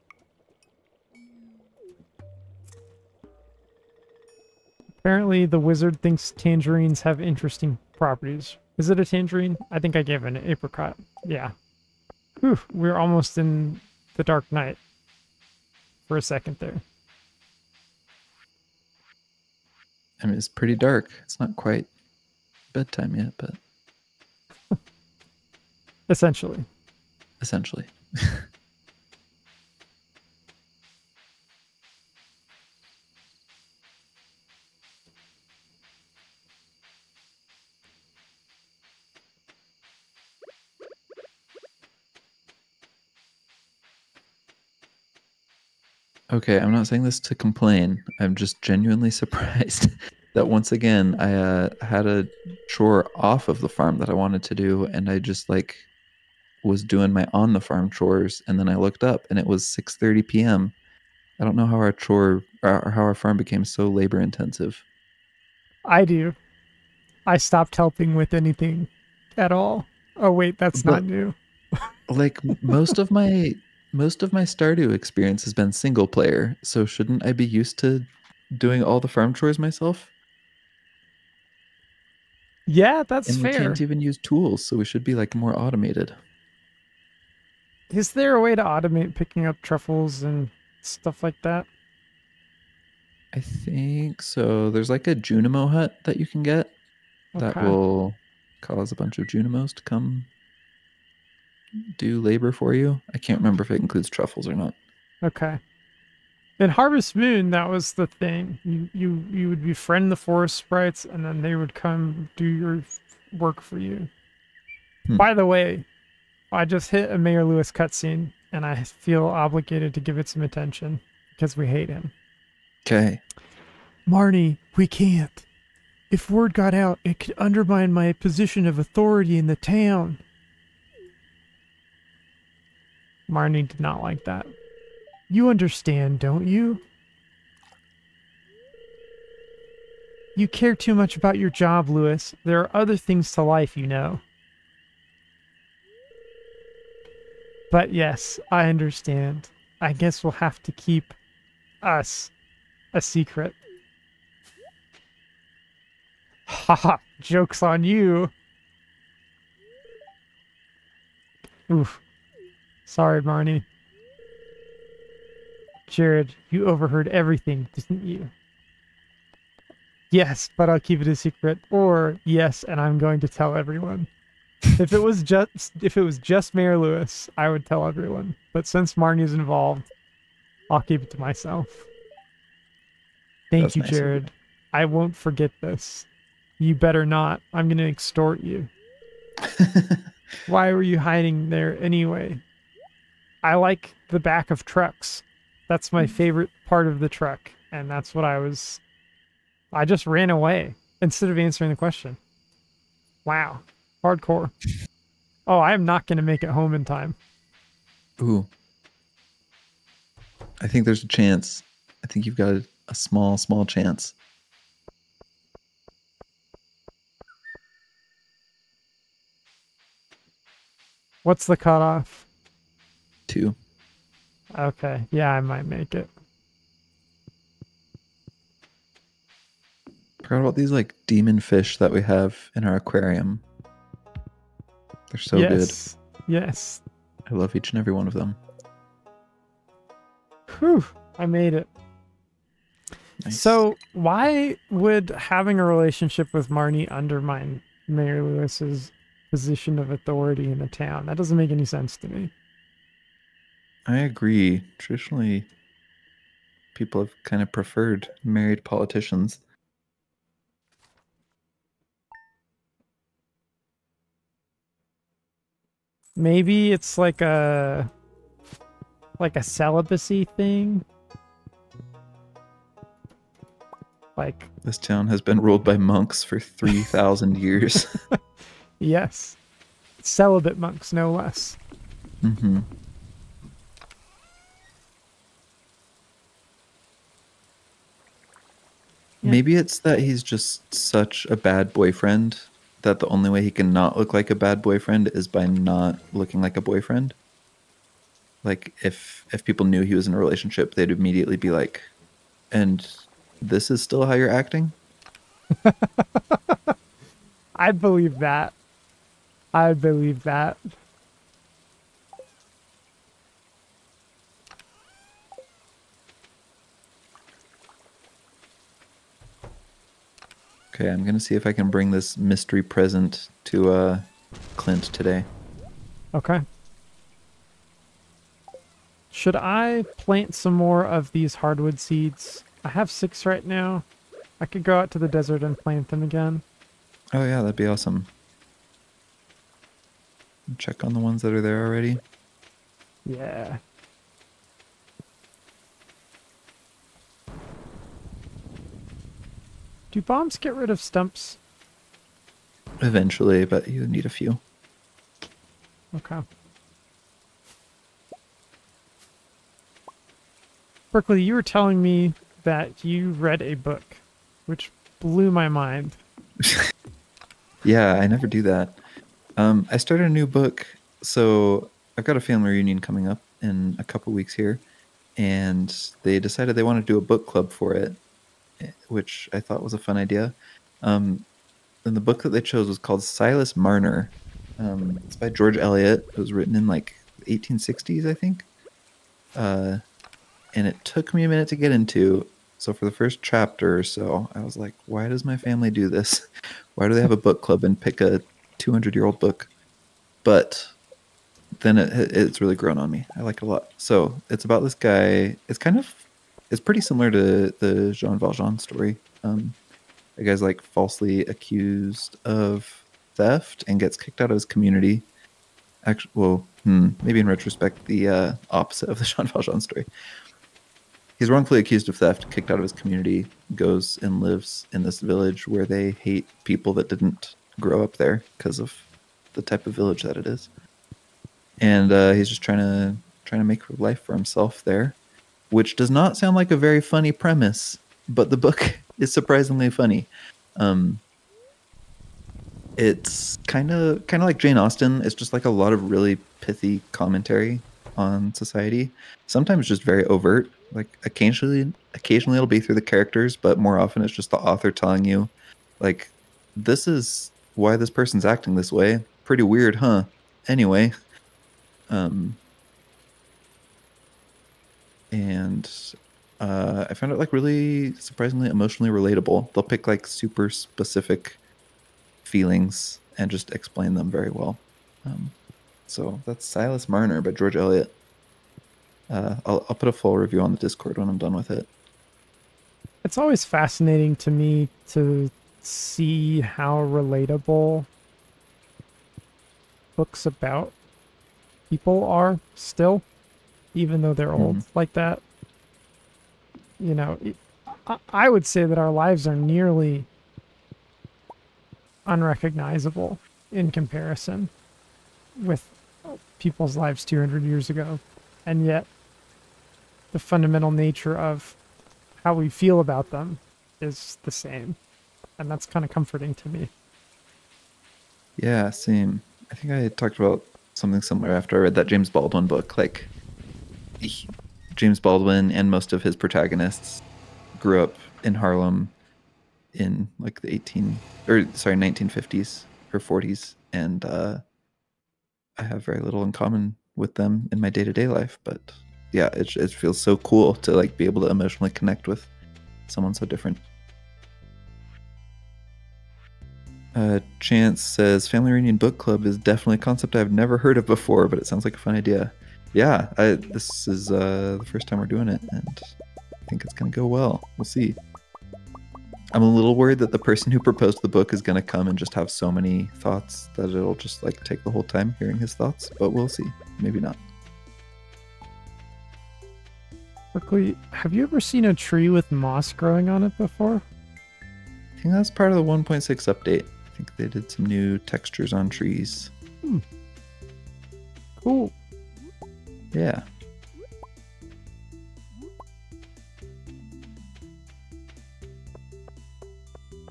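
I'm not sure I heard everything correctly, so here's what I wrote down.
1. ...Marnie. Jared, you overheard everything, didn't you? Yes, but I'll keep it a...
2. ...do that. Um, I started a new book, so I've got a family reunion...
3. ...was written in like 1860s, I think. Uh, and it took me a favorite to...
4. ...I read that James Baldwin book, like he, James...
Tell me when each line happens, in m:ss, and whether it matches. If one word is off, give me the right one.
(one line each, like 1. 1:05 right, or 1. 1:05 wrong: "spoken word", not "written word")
1. 2:43 right
2. 6:08 right
3. 6:26 wrong: "minute", not "favorite"
4. 8:41 right.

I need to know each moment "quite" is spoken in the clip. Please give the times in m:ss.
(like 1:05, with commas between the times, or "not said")
0:21.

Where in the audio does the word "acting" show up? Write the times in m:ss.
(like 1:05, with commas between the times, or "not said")
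5:04, 7:38.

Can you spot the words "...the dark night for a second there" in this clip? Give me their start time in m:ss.
0:14.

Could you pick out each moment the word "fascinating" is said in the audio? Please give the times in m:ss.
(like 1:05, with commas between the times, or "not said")
8:03.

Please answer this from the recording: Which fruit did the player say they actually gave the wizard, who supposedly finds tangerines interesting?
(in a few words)
apricot.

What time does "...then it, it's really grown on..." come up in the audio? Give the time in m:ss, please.
6:41.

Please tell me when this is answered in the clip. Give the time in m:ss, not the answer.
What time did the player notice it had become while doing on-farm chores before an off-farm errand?
0:59.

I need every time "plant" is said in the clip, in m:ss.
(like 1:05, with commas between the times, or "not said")
5:29, 5:35.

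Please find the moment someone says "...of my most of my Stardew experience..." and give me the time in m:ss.
1:12.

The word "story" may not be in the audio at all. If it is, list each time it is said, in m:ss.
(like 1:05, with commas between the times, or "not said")
6:48, 6:59.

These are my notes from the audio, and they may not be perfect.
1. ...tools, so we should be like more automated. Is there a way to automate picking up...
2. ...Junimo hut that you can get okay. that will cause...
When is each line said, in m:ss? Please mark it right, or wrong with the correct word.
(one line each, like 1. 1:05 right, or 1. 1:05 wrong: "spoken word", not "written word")
1. 1:24 right
2. 1:35 right.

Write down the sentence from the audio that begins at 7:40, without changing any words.
Anyway, um, and uh, I found it like really surprisingly emotionally relatable.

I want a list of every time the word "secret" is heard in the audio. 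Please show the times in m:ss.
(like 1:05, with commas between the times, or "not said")
2:33, 2:51.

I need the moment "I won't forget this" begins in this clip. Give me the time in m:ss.
3:04.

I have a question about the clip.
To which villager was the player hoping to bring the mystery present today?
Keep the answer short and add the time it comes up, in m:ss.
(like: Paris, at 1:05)
Clint, at 5:24.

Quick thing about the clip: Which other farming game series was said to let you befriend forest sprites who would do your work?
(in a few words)
Harvest Moon.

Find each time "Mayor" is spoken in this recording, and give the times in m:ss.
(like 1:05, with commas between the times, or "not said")
1:57, 2:56, 4:07.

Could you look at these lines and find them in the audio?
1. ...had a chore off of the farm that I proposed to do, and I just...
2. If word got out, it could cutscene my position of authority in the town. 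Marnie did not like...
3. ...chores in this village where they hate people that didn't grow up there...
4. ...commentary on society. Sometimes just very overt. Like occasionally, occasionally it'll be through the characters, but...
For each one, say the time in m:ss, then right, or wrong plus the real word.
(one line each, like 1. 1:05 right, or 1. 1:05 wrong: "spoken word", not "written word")
1. 0:51 wrong: "wanted", not "proposed"
2. 2:06 wrong: "undermine", not "cutscene"
3. 7:04 wrong: "lives", not "chores"
4. 7:26 right.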